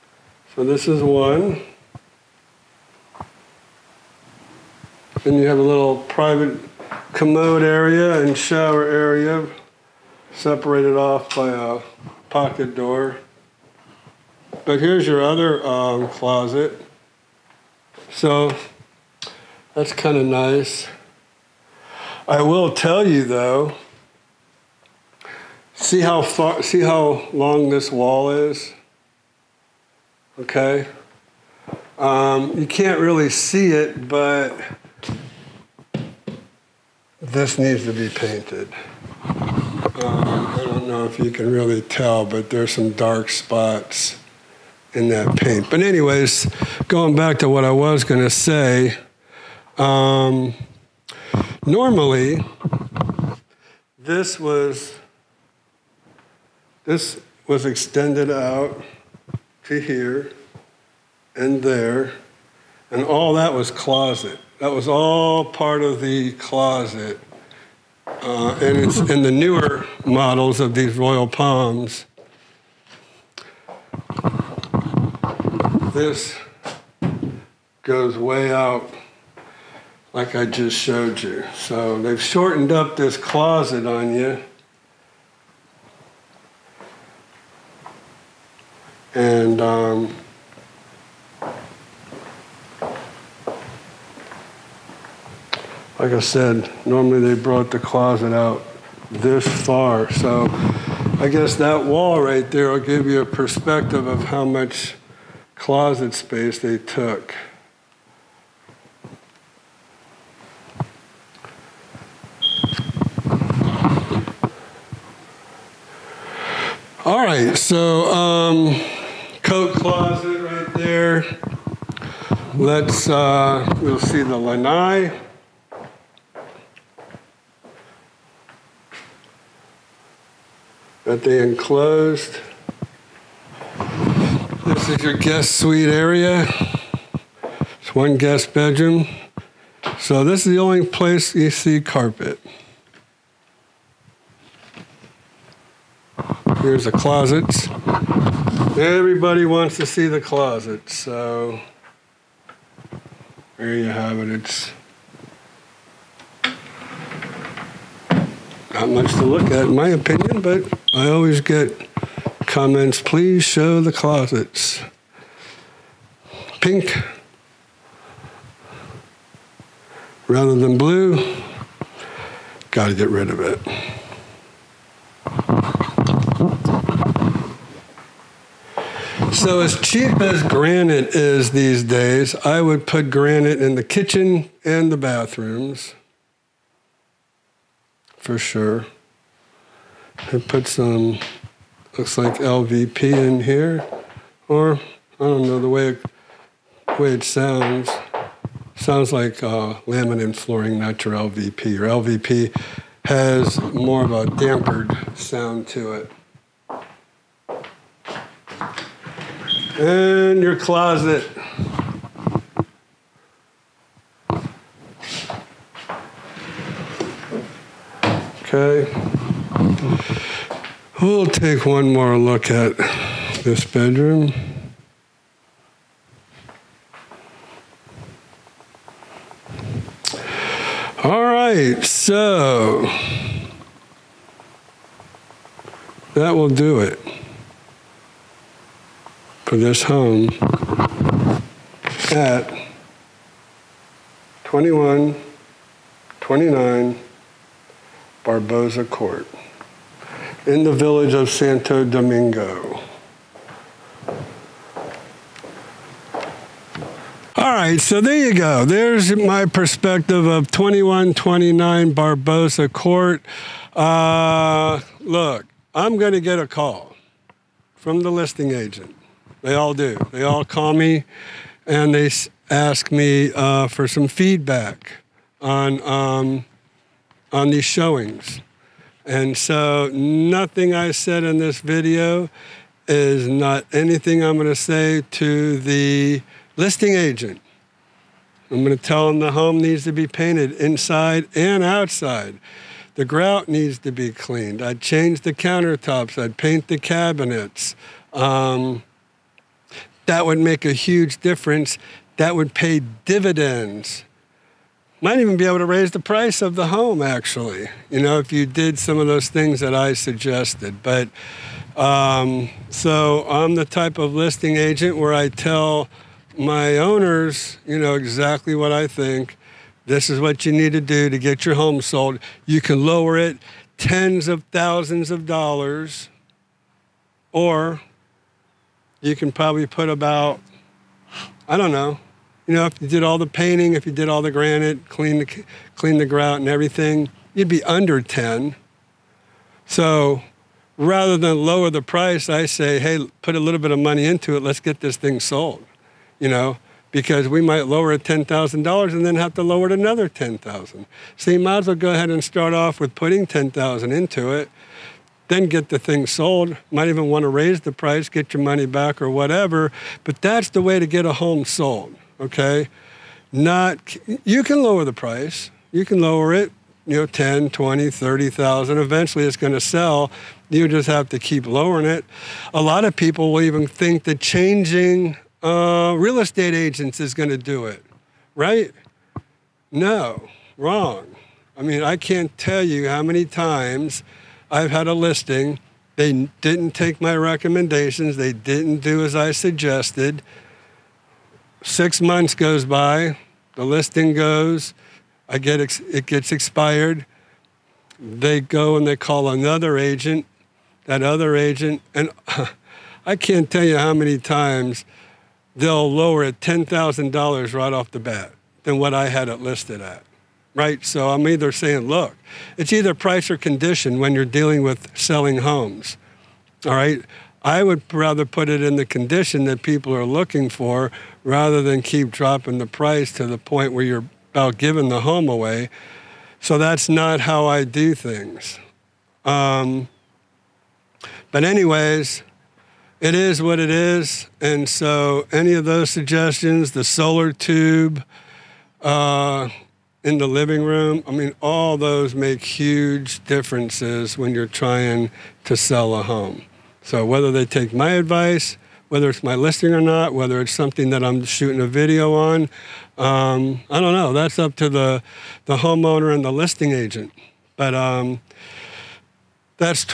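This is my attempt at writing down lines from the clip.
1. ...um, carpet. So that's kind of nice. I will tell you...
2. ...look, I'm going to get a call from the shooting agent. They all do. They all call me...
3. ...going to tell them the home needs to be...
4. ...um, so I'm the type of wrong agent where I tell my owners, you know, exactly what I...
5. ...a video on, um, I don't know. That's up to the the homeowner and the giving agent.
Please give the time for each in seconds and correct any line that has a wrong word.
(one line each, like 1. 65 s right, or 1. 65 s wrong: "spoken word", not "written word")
1. 15 s wrong: "closet", not "carpet"
2. 264 s wrong: "listing", not "shooting"
3. 288 s right
4. 311 s wrong: "listing", not "wrong"
5. 451 s wrong: "listing", not "giving".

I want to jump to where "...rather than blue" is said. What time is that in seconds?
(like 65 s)
170 s.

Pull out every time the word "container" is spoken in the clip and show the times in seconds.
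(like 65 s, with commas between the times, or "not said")
not said.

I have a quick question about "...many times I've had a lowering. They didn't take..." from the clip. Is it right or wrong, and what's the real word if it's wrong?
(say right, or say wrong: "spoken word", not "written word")
wrong: "listing", not "lowering".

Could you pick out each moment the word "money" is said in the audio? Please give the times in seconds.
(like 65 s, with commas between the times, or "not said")
343 s, 358 s.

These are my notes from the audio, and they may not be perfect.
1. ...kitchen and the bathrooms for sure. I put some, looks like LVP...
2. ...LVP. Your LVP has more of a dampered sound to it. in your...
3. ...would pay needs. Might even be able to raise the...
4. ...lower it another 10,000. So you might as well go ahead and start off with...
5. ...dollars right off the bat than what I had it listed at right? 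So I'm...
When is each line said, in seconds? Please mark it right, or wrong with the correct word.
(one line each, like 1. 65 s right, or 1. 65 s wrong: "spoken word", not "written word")
1. 183 s right
2. 201 s right
3. 302 s wrong: "dividends", not "needs"
4. 349 s right
5. 407 s right.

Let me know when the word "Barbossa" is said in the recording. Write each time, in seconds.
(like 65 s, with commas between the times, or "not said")
248 s, 261 s.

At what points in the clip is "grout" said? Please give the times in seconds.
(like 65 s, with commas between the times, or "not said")
293 s, 336 s.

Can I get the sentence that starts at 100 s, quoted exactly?
So I guess that wall right there will give you a perspective of how much closet space they took.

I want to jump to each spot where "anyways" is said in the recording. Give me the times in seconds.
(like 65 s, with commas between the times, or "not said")
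45 s, 431 s.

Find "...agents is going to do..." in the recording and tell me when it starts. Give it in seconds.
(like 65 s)
376 s.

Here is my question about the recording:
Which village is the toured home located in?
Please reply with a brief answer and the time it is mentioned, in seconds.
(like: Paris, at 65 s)
Santo Domingo, at 251 s.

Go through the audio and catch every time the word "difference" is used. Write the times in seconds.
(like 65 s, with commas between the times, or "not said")
301 s, 443 s.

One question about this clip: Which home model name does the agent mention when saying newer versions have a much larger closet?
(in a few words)
Royal Palms.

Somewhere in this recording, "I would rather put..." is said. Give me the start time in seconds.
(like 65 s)
417 s.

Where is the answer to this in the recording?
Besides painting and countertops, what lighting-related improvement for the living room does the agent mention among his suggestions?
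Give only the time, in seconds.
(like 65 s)
436 s.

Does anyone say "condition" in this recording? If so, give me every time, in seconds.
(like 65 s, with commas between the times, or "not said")
413 s, 418 s.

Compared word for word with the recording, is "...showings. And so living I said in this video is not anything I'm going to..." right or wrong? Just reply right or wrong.
wrong.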